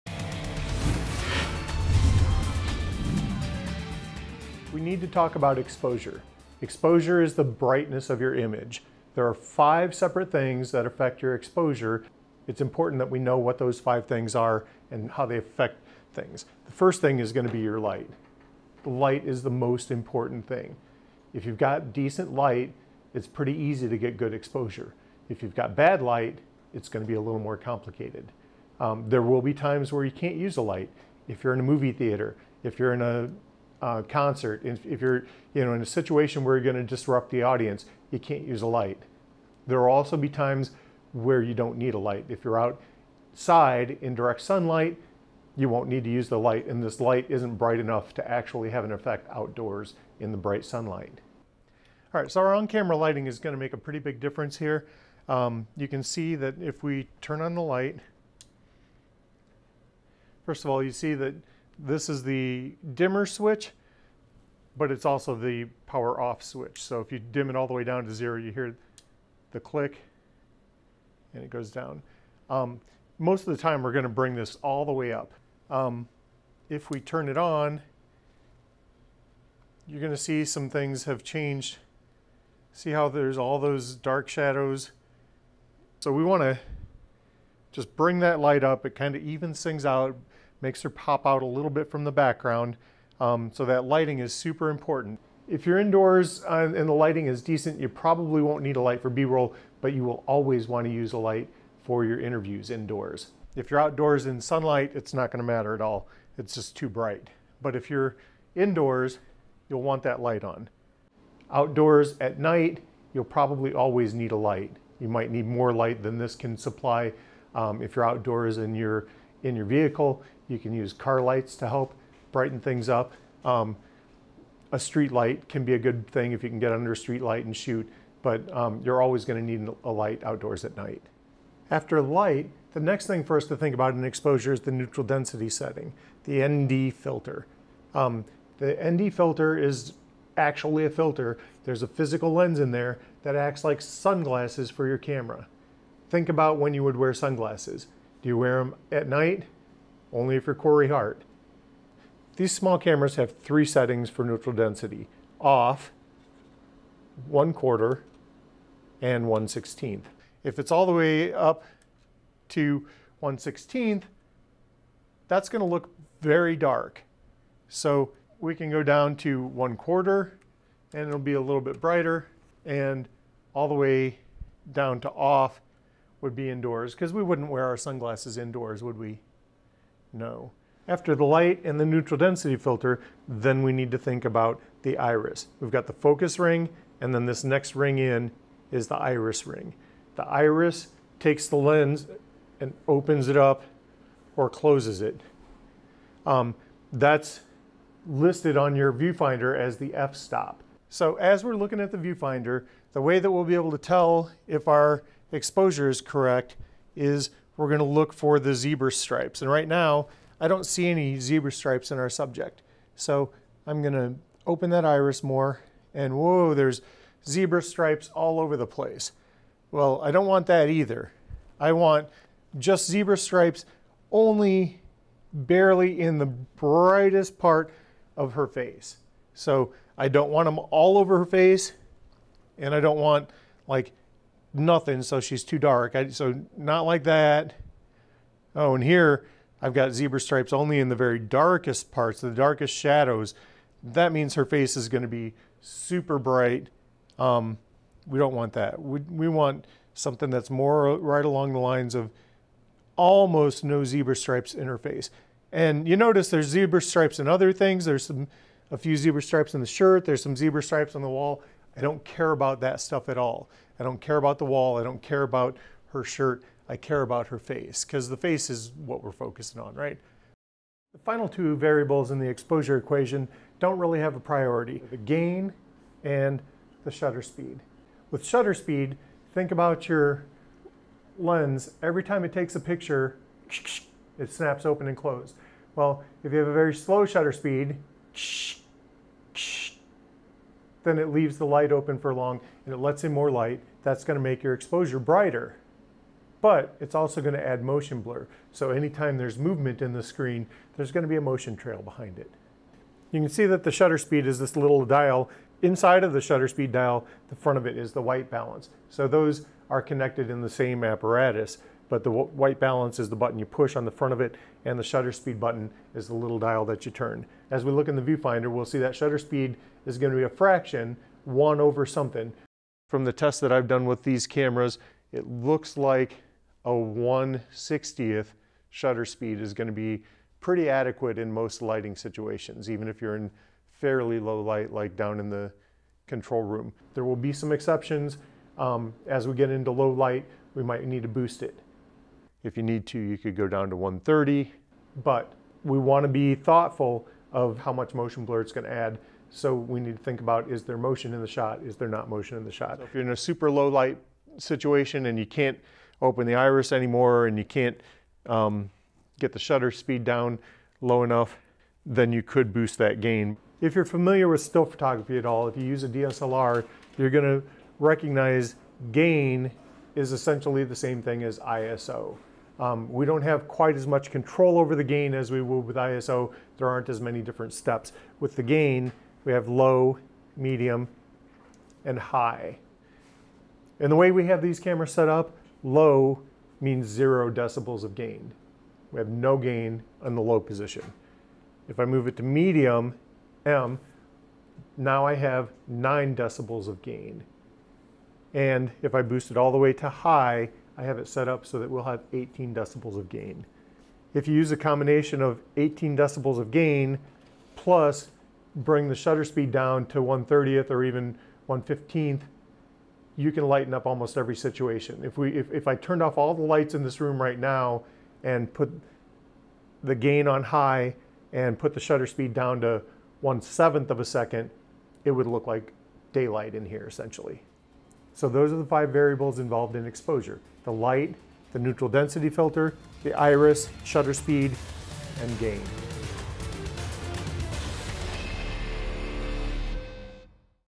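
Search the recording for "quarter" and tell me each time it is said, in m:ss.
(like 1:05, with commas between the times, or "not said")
2:37, 2:49.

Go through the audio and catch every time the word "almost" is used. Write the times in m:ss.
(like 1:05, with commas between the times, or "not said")
4:12, 6:53.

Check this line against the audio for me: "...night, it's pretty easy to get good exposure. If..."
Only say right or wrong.
wrong.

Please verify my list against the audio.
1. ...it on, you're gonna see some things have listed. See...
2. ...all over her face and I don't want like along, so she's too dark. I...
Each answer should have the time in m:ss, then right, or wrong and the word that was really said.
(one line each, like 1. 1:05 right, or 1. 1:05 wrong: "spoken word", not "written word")
1. 1:17 wrong: "changed", not "listed"
2. 3:50 wrong: "nothing", not "along".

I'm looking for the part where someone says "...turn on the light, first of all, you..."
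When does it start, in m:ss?
0:57.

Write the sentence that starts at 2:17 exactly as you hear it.
Um, the ND filter is actually a filter.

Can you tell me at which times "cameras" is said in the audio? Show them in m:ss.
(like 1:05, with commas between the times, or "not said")
0:52, 2:24, 2:32, 5:24, 6:24.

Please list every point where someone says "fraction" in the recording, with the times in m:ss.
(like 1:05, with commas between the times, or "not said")
5:20.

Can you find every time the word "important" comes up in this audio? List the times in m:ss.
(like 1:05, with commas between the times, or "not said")
0:12, 0:19, 1:34.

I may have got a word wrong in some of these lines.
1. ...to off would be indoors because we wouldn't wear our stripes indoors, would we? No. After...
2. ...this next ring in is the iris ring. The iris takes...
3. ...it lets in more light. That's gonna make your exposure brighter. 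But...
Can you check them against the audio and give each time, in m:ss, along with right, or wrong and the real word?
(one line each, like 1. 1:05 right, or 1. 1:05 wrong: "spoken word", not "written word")
1. 2:54 wrong: "sunglasses", not "stripes"
2. 3:07 right
3. 4:52 right.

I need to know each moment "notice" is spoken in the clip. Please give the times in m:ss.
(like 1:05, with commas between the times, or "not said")
4:15.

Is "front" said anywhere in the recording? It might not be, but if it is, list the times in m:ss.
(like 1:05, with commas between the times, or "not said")
5:07, 5:13.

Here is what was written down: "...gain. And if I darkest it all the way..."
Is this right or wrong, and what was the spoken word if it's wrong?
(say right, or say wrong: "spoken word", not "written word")
wrong: "boost", not "darkest".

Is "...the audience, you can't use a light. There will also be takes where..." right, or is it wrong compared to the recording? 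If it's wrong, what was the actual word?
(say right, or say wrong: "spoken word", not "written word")
wrong: "times", not "takes".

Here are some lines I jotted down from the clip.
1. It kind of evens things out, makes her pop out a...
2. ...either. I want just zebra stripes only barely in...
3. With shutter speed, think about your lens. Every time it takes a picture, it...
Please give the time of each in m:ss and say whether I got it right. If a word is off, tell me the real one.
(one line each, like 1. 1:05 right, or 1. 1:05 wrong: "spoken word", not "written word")
1. 1:28 right
2. 3:40 right
3. 4:38 right.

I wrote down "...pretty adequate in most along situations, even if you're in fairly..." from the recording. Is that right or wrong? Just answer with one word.
wrong.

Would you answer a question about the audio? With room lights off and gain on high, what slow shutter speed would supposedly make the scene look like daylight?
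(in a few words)
1/7 of a second.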